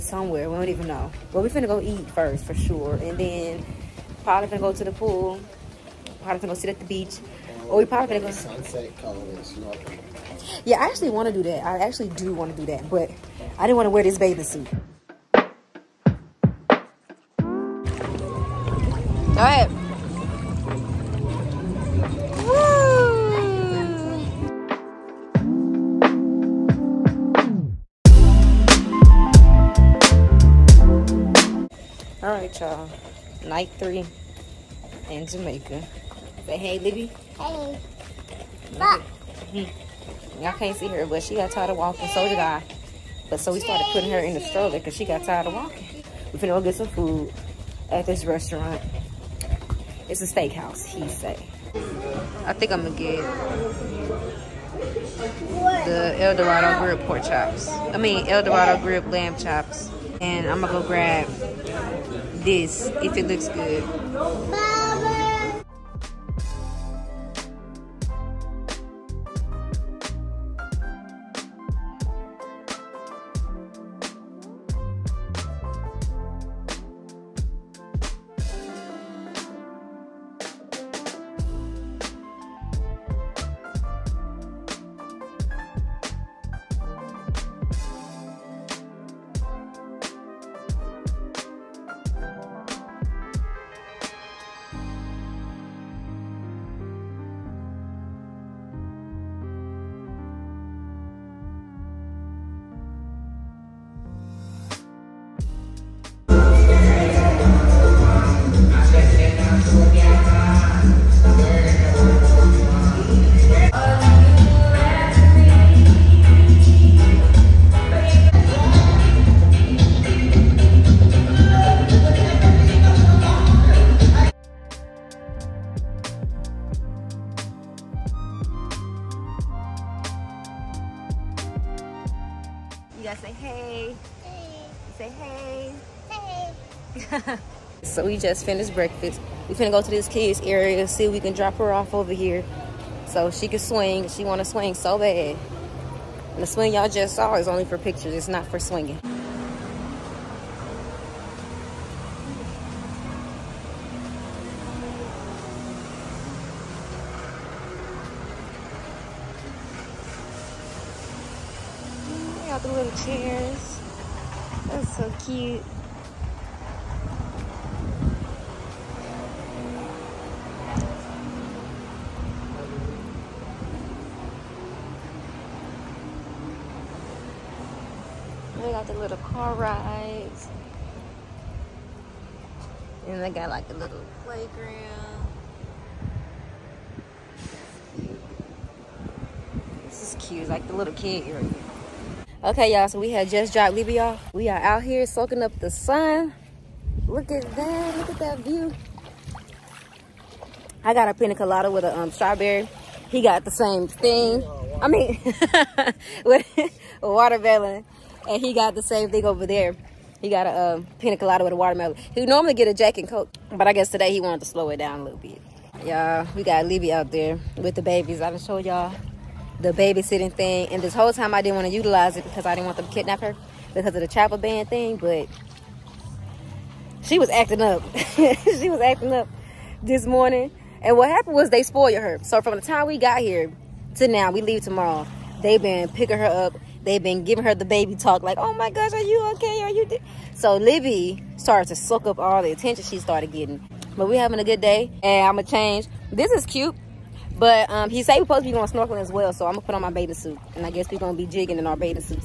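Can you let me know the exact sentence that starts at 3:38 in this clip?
I done showed y'all the babysitting thing.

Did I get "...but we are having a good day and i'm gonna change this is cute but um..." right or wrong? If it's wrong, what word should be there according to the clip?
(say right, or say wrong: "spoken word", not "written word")
right.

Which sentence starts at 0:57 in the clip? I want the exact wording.
I mean, El Dorado grilled lamb chops.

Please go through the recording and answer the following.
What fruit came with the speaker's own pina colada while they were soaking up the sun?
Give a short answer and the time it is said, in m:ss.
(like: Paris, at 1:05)
Strawberry, at 3:22.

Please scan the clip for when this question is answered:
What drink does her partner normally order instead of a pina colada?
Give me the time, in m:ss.
3:32.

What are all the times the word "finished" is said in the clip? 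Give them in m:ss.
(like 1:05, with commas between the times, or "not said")
2:18.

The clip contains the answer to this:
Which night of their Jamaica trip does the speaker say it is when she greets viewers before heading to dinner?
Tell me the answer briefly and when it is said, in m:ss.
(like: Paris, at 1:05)
Night 3, at 0:33.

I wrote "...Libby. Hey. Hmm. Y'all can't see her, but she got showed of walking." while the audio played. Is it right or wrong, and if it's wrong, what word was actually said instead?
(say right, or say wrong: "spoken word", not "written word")
wrong: "tired", not "showed".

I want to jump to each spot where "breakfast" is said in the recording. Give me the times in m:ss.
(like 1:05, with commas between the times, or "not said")
2:18.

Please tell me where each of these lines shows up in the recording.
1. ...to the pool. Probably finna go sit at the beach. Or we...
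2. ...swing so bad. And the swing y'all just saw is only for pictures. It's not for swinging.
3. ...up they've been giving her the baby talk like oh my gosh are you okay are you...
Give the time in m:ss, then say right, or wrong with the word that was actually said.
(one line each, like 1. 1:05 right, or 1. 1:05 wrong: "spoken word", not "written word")
1. 0:04 wrong: "gonna", not "finna"
2. 2:24 right
3. 3:56 right.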